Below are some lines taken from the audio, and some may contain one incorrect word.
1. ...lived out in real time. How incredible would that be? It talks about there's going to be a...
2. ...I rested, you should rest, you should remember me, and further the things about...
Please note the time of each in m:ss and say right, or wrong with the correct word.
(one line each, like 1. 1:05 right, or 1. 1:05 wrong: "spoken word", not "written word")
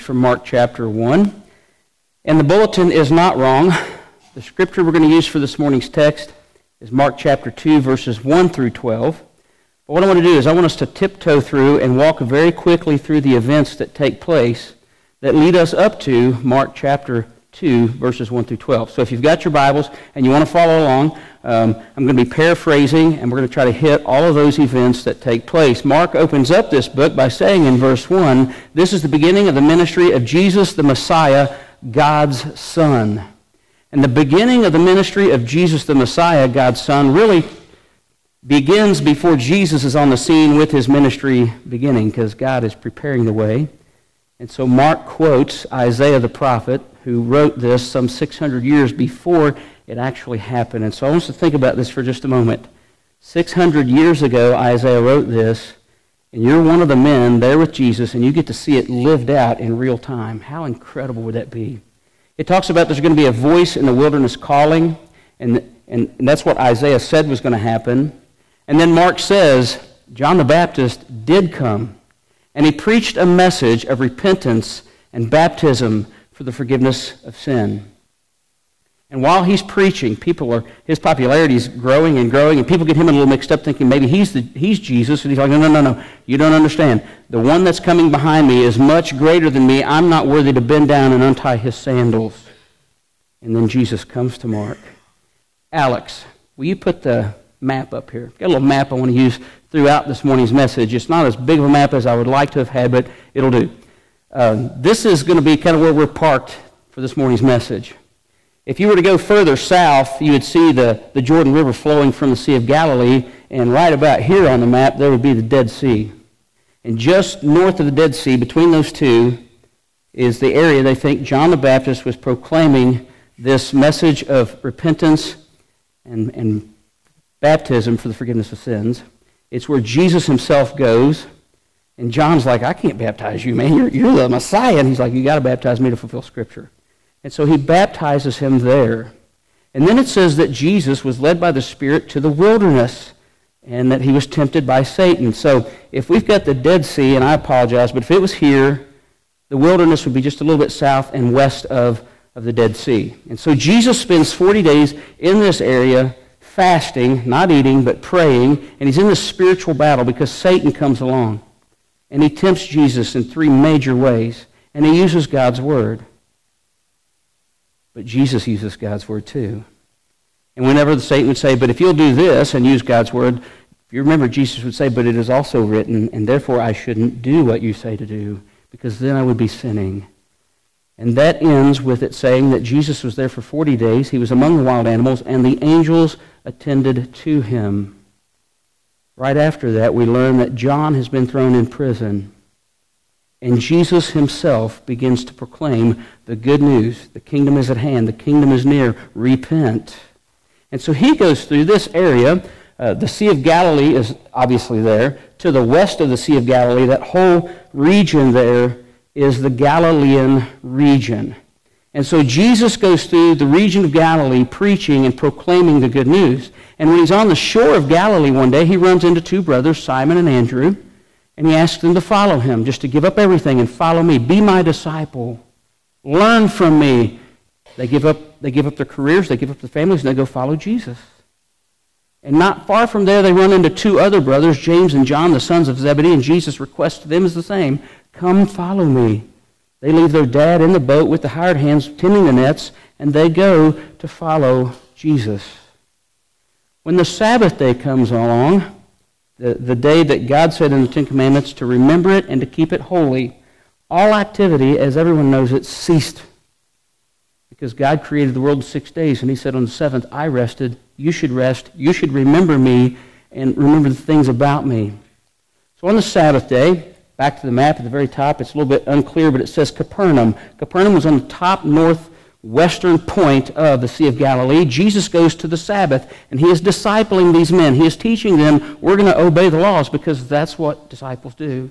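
1. 0:58 right
2. 4:20 wrong: "remember", not "further".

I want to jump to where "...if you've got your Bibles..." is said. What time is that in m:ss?
0:19.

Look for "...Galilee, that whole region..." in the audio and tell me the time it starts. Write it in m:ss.
3:26.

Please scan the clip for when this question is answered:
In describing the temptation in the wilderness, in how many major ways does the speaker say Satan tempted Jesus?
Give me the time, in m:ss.
2:43.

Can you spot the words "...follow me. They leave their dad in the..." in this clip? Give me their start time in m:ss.
3:58.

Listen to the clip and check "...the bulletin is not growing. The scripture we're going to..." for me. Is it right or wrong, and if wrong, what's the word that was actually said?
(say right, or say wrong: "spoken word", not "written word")
wrong: "wrong", not "growing".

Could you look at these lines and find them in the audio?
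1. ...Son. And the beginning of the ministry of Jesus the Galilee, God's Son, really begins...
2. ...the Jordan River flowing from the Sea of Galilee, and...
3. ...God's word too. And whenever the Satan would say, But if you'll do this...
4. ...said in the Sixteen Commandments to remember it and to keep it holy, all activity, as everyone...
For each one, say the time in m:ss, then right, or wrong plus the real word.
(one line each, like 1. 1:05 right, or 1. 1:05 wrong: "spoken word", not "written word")
1. 0:32 wrong: "Messiah", not "Galilee"
2. 1:51 right
3. 2:48 right
4. 4:10 wrong: "Ten", not "Sixteen".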